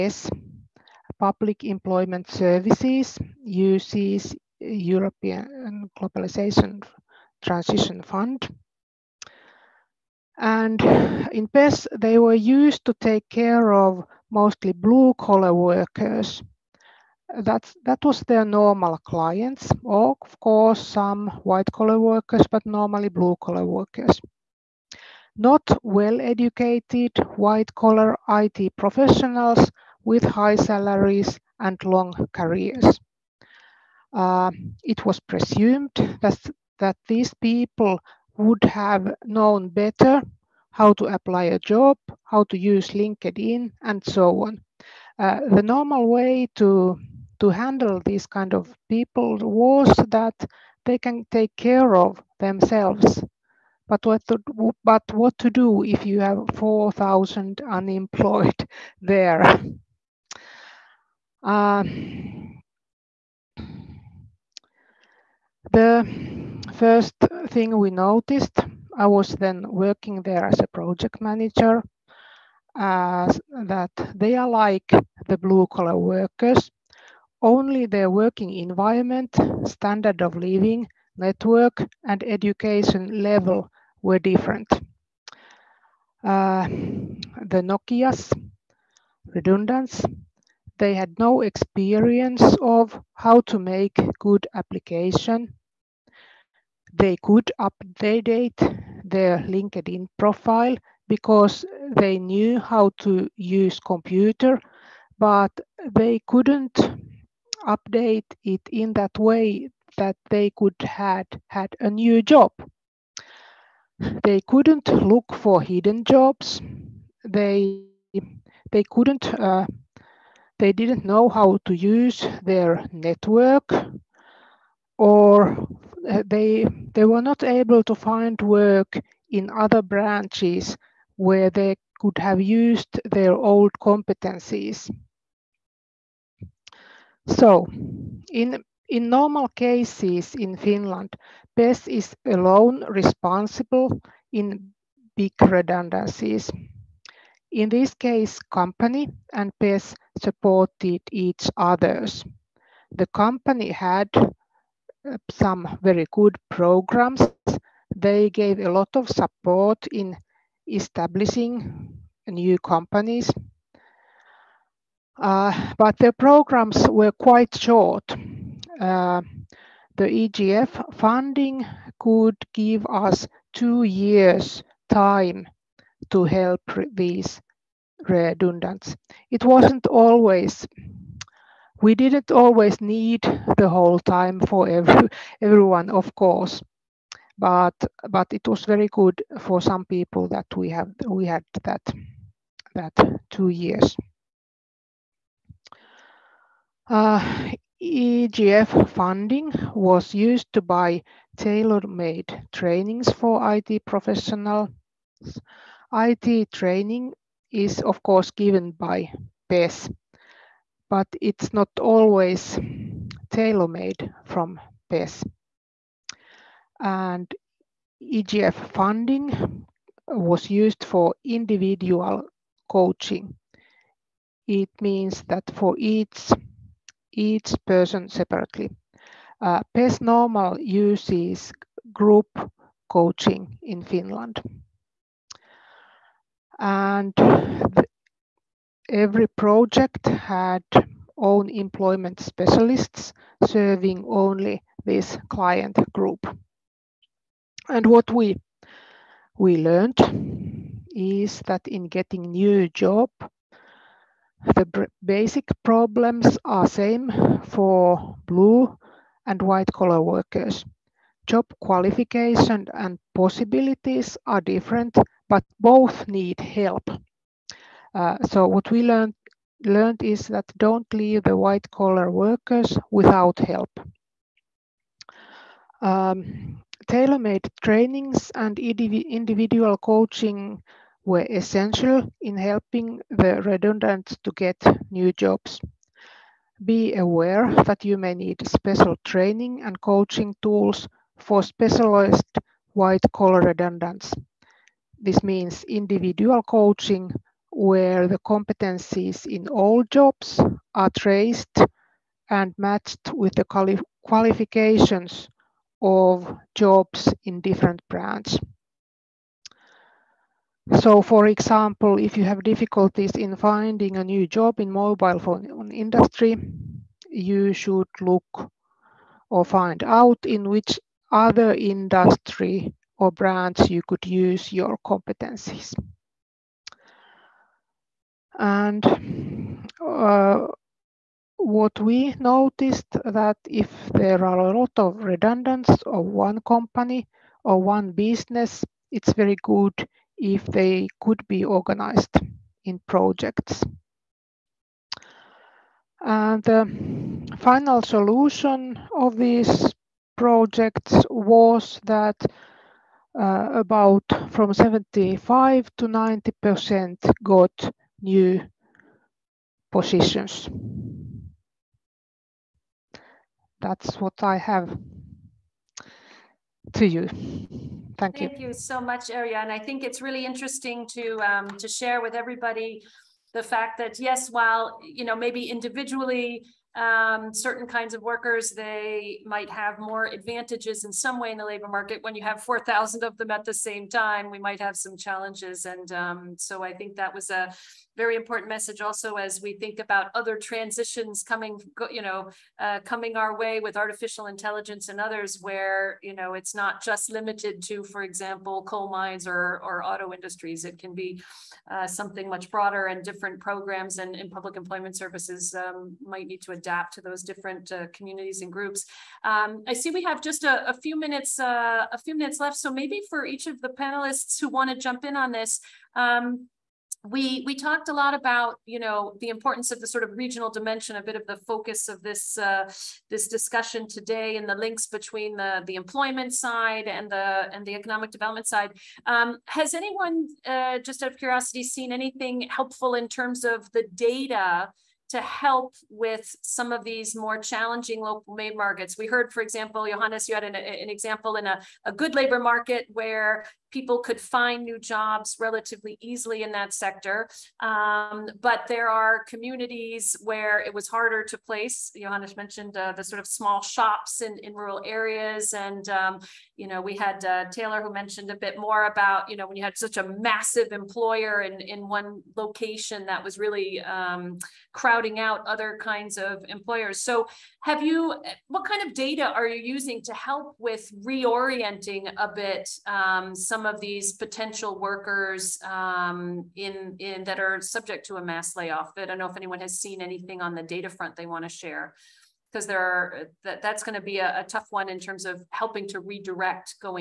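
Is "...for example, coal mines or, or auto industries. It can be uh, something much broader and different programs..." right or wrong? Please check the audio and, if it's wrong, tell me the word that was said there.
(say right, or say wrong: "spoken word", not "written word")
right.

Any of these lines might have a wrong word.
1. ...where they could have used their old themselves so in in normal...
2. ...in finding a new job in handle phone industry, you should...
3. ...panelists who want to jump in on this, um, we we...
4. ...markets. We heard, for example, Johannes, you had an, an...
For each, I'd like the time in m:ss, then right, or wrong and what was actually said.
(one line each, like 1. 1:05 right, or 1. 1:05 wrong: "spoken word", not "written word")
1. 2:11 wrong: "competencies", not "themselves"
2. 5:13 wrong: "mobile", not "handle"
3. 6:53 right
4. 7:18 right.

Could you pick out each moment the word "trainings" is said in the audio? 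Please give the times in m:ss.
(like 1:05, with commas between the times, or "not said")
3:22, 3:26, 4:37, 4:49.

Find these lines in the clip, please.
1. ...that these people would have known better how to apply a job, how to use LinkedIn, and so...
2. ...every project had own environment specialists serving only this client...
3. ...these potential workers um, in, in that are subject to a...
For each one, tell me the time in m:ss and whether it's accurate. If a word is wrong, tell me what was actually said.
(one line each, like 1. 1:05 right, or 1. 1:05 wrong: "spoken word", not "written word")
1. 0:36 right
2. 3:58 wrong: "employment", not "environment"
3. 7:53 right.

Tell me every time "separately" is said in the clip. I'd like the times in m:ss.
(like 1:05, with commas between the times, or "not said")
3:48.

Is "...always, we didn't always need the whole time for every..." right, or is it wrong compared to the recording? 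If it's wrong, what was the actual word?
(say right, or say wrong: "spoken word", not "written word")
right.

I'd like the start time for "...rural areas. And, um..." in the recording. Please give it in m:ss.
7:34.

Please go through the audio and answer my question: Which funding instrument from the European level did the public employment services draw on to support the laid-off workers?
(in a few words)
European Globalization Transition Fund.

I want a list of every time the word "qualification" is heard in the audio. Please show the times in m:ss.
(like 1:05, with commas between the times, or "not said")
4:21, 5:04.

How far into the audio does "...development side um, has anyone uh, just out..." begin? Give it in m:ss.
7:08.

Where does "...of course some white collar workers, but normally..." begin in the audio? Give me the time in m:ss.
0:20.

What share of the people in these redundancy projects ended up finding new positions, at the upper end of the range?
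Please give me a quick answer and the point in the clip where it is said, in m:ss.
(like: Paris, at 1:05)
90 percent, at 5:55.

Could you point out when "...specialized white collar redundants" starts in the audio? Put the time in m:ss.
4:51.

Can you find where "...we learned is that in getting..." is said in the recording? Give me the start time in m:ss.
4:09.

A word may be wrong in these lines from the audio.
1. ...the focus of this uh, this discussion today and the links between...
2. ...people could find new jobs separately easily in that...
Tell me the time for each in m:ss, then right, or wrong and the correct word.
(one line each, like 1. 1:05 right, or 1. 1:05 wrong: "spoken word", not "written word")
1. 7:01 right
2. 7:23 wrong: "relatively", not "separately".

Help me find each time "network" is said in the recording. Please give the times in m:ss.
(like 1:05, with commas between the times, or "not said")
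1:21, 2:02.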